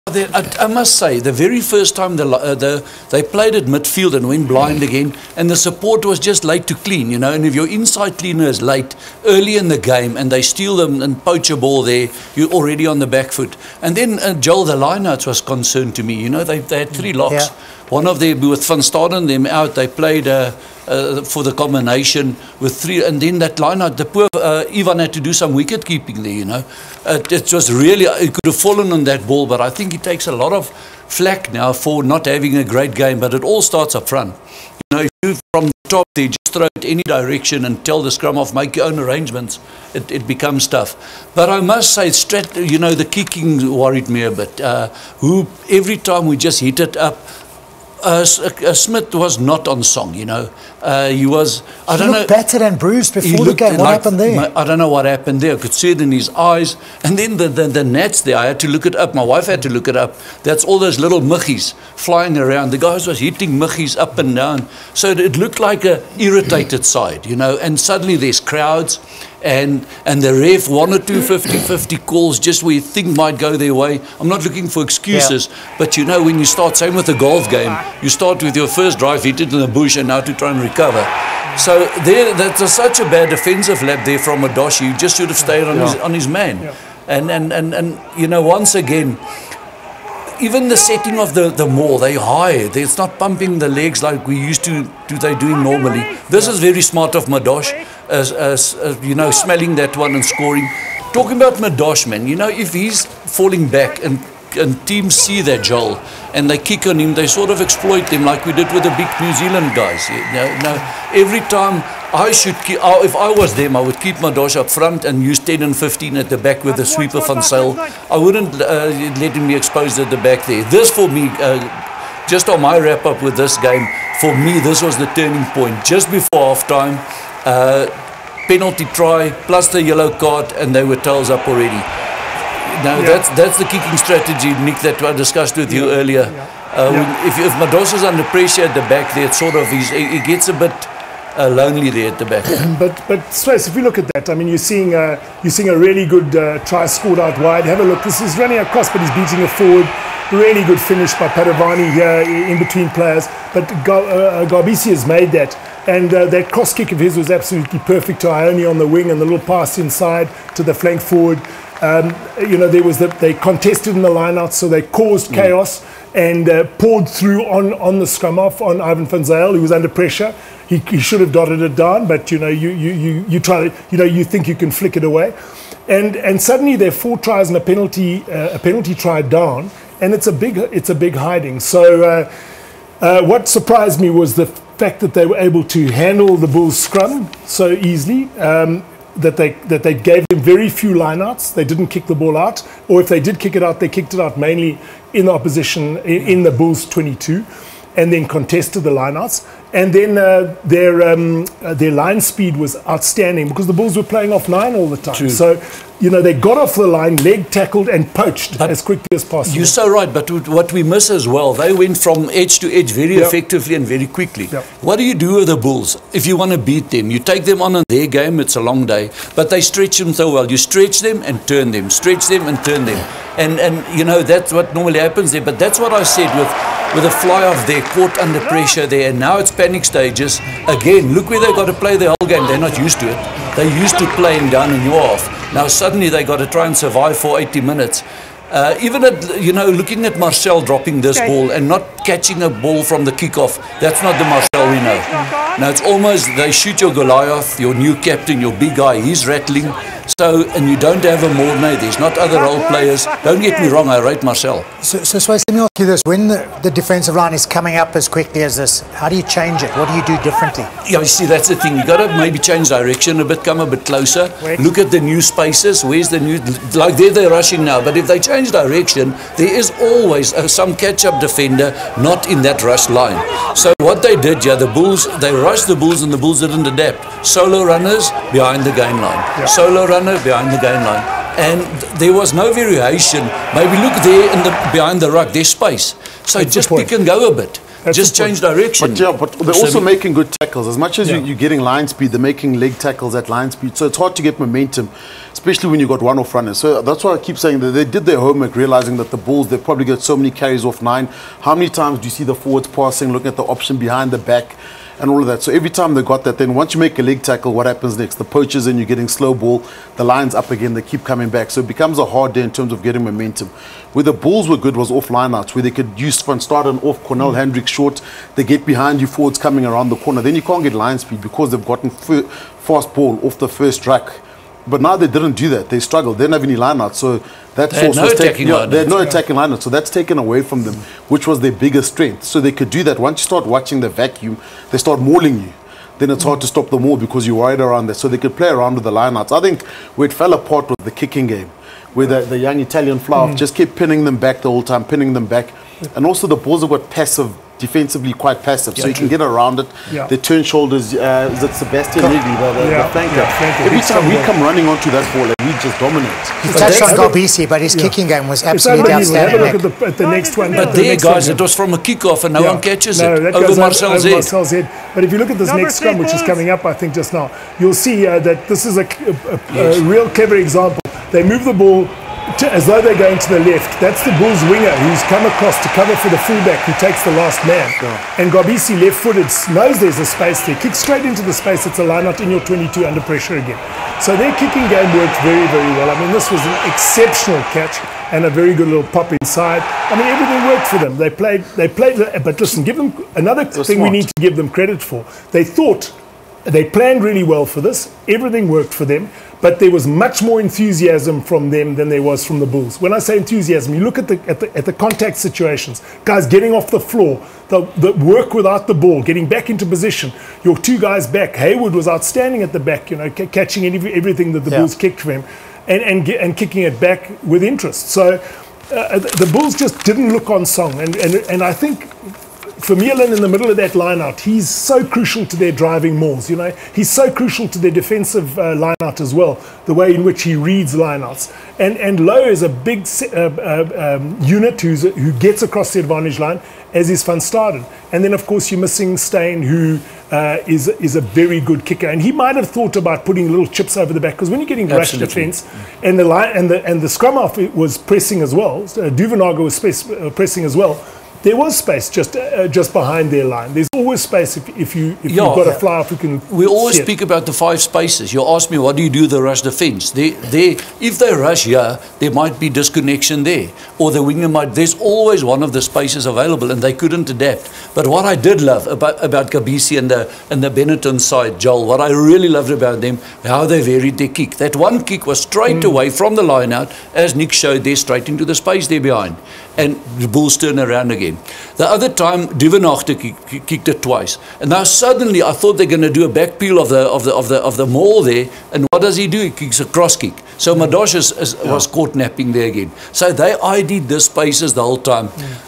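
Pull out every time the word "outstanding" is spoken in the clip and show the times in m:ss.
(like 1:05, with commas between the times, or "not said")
3:22, 5:58, 6:51.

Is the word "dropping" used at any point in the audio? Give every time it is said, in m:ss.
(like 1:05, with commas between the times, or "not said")
4:00.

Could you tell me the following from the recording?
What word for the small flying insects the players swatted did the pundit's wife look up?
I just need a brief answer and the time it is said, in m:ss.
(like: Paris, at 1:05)
gnats, at 0:57.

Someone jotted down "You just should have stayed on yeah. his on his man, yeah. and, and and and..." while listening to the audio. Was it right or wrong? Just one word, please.
right.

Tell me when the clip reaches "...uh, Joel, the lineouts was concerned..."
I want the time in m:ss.
0:14.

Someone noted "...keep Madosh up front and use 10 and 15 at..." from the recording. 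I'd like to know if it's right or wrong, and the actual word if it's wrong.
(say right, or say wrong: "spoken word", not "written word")
right.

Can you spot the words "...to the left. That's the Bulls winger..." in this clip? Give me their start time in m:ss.
6:13.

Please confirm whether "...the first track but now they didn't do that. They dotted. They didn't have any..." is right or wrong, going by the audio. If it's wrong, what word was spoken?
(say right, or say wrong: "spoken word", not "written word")
wrong: "struggled", not "dotted".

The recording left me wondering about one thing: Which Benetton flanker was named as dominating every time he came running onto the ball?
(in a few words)
Sebastian Rigby.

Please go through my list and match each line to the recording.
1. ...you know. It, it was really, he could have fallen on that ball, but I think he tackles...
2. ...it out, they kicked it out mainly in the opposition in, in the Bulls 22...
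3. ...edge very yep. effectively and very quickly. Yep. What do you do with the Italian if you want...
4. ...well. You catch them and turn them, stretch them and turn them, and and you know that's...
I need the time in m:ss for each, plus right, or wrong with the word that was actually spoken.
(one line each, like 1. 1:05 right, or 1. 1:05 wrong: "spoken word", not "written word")
1. 0:26 wrong: "takes", not "tackles"
2. 3:13 right
3. 3:32 wrong: "Bulls", not "Italian"
4. 3:40 wrong: "stretch", not "catch".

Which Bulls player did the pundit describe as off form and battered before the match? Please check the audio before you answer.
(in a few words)
Smith.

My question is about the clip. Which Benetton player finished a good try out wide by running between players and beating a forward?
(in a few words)
Padovani.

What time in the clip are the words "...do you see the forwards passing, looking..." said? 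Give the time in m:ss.
5:01.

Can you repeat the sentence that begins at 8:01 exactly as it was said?
The other time, Duvenage kicked it twice.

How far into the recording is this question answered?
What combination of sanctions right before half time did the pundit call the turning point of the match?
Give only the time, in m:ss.
2:08.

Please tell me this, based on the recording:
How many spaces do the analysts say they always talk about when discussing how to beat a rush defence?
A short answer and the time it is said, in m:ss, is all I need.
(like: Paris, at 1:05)
5, at 7:37.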